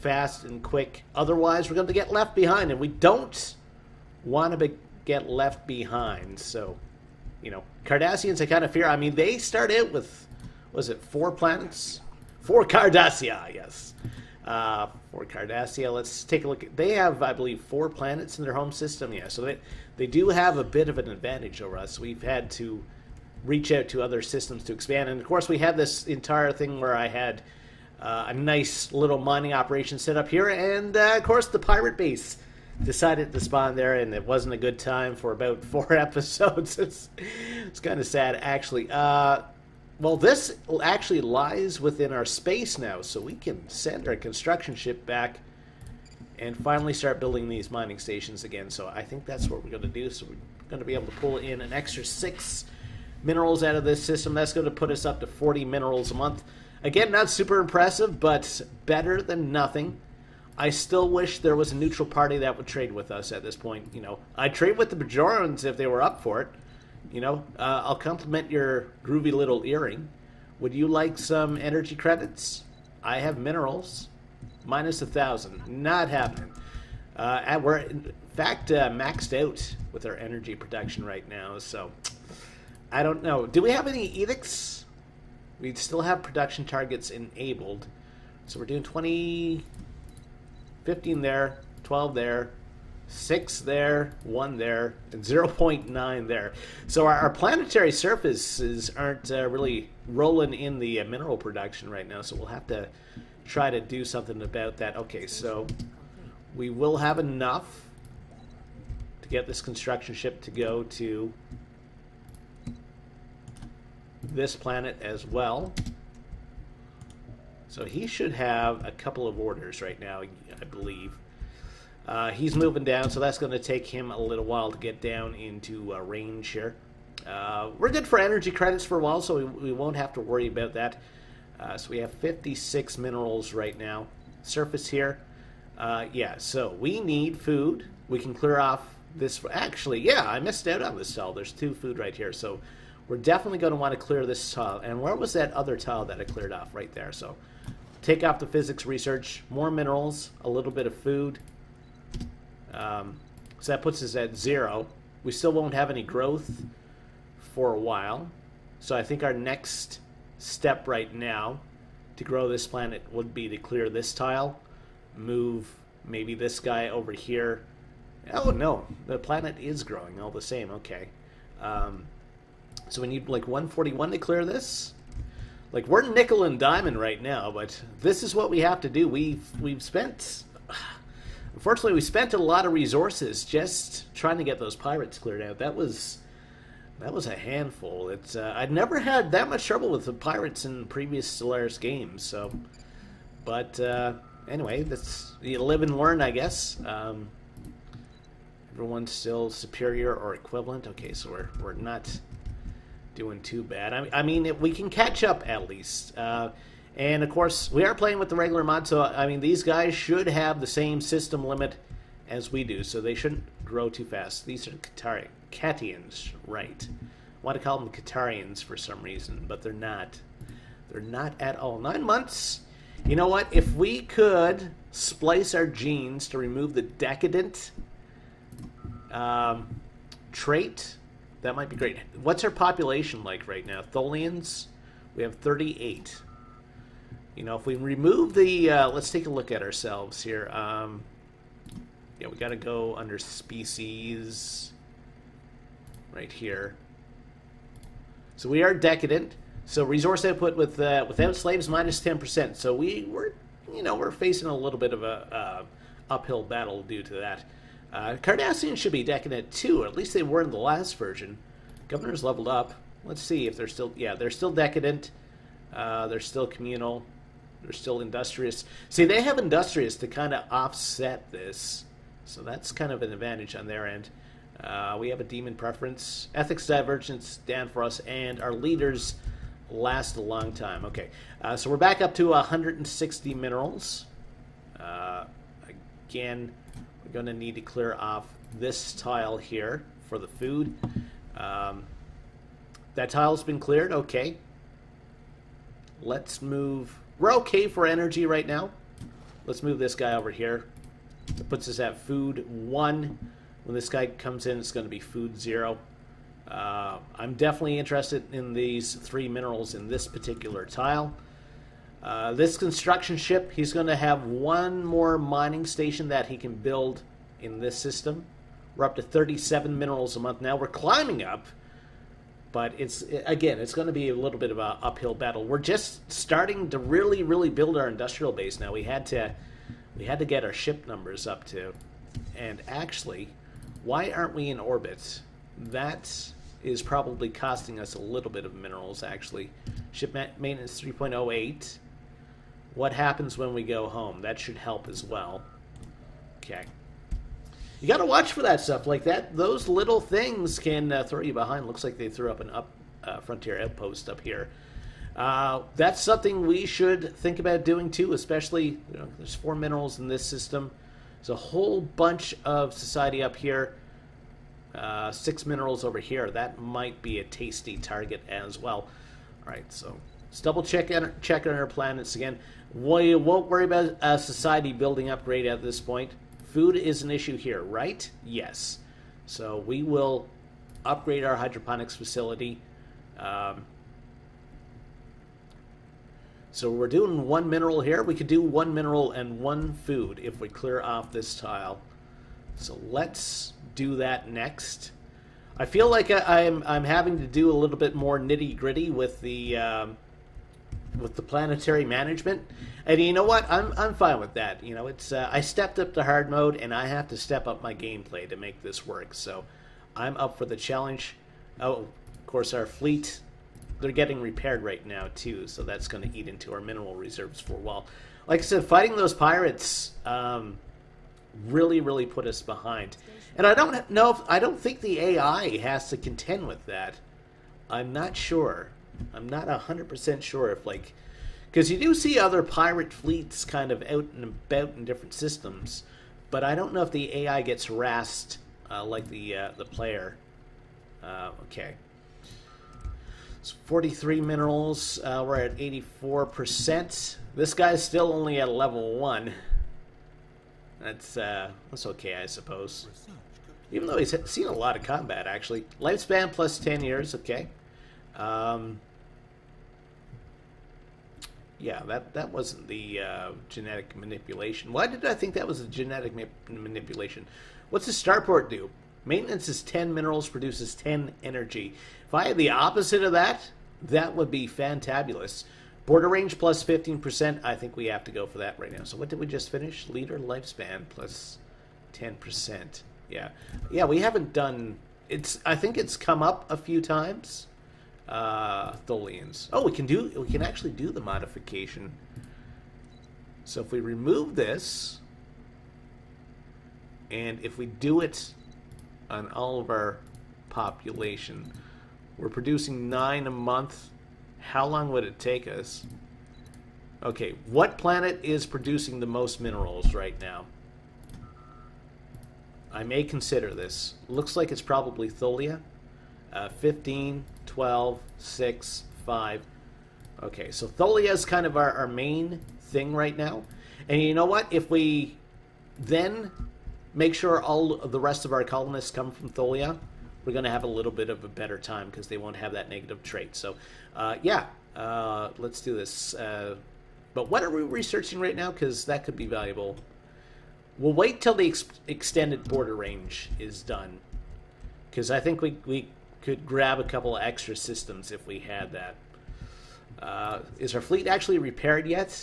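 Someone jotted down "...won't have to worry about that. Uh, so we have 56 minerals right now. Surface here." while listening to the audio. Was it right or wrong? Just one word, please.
right.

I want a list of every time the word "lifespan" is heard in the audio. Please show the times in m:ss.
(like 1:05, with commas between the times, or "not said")
7:35, 8:00.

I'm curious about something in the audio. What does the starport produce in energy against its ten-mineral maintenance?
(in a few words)
10 energy.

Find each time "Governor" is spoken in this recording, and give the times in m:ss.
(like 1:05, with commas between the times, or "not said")
4:21.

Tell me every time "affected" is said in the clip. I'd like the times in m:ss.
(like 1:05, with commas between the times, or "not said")
not said.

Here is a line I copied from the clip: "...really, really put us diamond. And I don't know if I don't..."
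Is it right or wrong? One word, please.
wrong.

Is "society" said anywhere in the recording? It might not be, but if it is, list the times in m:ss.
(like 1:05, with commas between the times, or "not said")
6:02, 6:14.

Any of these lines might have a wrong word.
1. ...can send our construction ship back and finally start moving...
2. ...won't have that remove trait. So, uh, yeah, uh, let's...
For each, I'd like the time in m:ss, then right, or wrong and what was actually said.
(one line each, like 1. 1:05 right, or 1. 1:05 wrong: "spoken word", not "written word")
1. 0:43 wrong: "building", not "moving"
2. 8:52 wrong: "negative", not "remove".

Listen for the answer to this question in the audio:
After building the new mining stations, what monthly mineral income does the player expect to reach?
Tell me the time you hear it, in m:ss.
0:55.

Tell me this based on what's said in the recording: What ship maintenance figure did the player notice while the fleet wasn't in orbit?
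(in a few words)
3.08.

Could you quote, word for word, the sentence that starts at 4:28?
See, they have industrious to kind of offset this.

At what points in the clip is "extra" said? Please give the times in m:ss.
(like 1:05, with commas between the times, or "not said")
0:51, 9:07.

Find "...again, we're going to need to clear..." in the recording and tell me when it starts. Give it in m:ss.
4:46.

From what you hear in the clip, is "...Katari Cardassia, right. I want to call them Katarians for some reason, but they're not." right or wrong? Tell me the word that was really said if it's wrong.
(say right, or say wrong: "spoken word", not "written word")
wrong: "Katians", not "Cardassia".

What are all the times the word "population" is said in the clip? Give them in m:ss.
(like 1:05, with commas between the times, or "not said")
3:52, 8:20.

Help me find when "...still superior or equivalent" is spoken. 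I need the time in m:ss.
3:19.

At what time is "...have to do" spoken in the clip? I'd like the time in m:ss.
2:58.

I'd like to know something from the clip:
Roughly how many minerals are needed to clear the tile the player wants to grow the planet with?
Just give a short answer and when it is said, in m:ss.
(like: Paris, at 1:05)
141, at 2:53.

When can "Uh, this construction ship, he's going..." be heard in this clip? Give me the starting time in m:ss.
5:12.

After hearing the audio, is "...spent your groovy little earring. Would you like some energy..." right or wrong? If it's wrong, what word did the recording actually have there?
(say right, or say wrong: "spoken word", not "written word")
wrong: "compliment", not "spent".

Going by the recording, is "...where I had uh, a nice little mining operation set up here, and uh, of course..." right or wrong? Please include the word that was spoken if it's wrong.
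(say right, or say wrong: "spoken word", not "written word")
right.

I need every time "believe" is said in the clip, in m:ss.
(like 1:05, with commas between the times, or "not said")
0:17, 2:00.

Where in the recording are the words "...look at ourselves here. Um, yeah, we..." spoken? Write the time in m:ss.
3:59.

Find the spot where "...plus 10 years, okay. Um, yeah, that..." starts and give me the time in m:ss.
7:36.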